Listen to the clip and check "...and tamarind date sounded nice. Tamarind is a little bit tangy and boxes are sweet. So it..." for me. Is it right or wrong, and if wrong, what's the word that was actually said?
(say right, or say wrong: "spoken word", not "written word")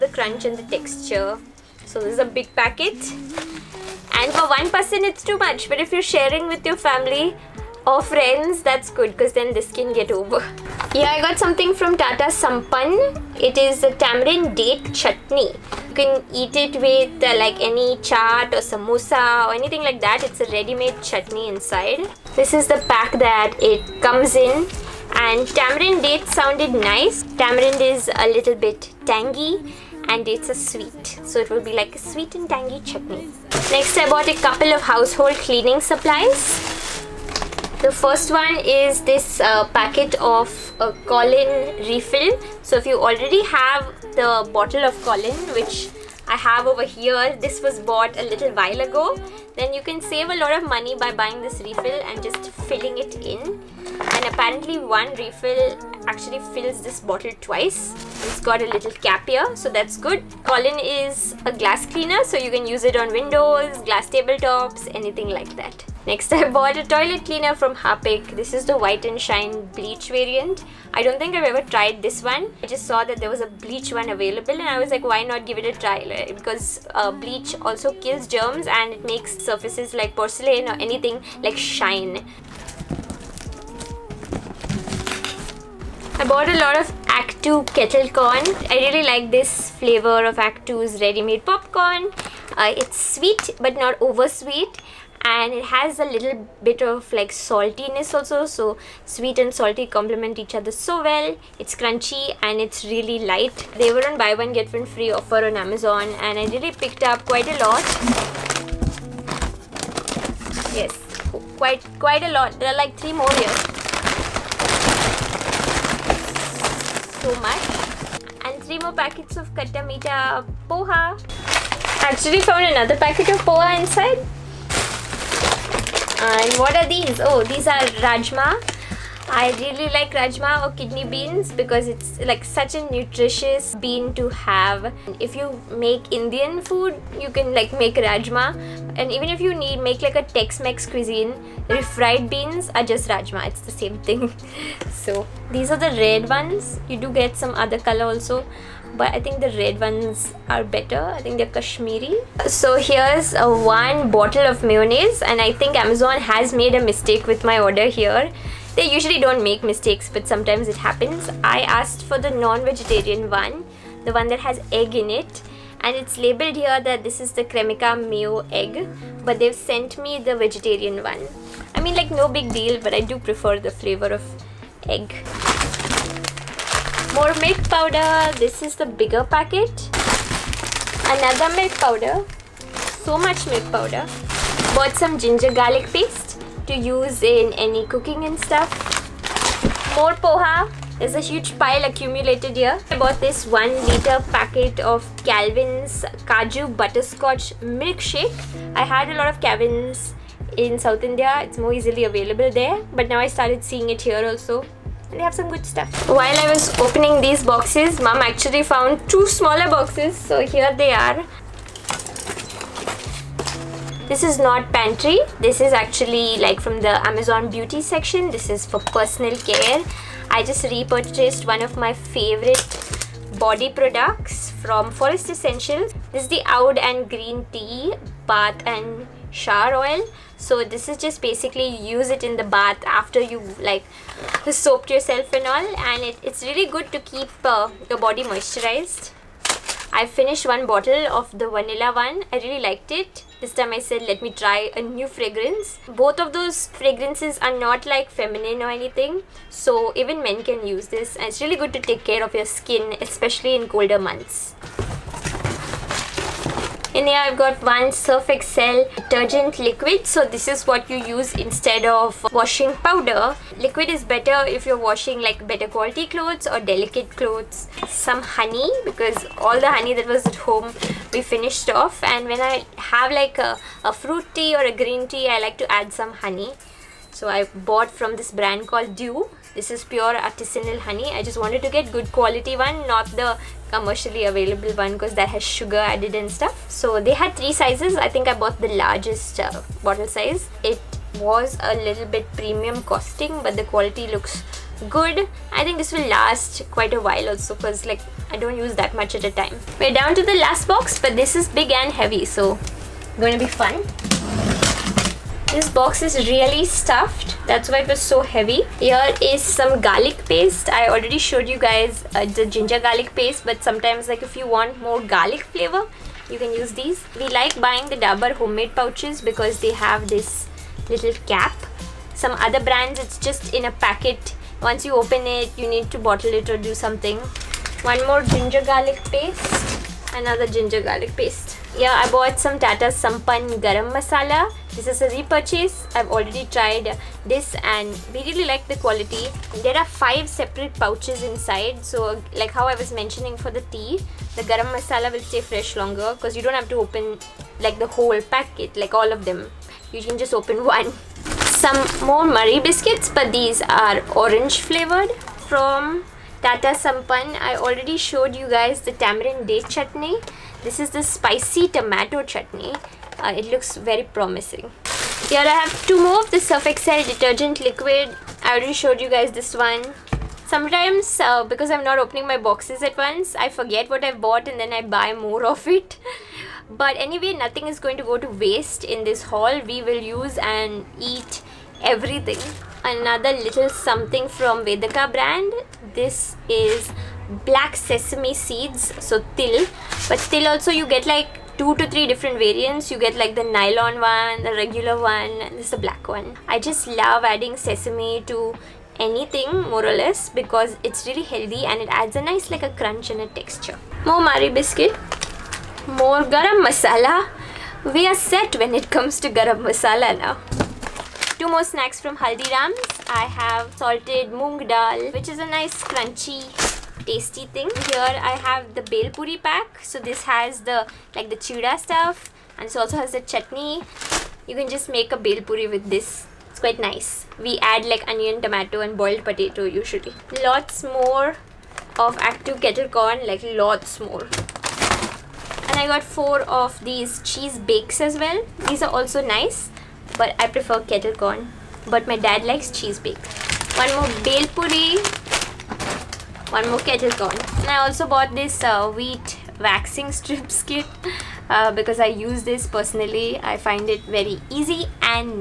wrong: "dates", not "boxes".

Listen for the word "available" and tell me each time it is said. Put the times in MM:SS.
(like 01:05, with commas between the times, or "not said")
01:14, 03:22, 04:44.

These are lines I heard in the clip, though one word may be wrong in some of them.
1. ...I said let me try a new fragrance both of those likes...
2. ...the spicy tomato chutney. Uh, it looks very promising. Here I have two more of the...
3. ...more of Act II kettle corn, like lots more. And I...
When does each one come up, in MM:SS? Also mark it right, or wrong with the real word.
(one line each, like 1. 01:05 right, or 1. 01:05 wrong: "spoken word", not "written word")
1. 04:03 wrong: "fragrances", not "likes"
2. 06:00 right
3. 07:10 right.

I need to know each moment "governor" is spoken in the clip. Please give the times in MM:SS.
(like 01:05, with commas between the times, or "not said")
not said.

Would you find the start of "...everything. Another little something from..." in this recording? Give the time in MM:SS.
06:21.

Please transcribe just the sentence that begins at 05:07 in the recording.
That's why it was so heavy.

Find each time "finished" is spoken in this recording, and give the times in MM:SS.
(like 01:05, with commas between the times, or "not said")
04:00, 04:31.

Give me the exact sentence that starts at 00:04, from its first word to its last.
And for one person, it's too much.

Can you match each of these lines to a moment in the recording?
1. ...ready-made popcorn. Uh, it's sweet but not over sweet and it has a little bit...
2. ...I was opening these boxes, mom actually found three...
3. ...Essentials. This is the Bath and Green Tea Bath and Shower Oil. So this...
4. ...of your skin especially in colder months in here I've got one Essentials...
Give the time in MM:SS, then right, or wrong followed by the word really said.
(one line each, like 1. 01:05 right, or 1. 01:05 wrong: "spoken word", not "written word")
1. 01:31 right
2. 03:26 wrong: "two", not "three"
3. 03:45 wrong: "Oud", not "Bath"
4. 04:12 wrong: "Surf", not "Essentials".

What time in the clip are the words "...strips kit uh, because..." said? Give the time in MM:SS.
07:30.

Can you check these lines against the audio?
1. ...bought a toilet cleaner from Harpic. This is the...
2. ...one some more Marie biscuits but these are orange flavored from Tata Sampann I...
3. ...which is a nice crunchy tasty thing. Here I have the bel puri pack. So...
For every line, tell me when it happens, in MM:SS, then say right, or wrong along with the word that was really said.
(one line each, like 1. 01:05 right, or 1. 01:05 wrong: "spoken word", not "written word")
1. 01:06 right
2. 05:50 right
3. 06:55 right.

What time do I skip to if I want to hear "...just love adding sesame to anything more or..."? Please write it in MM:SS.
06:36.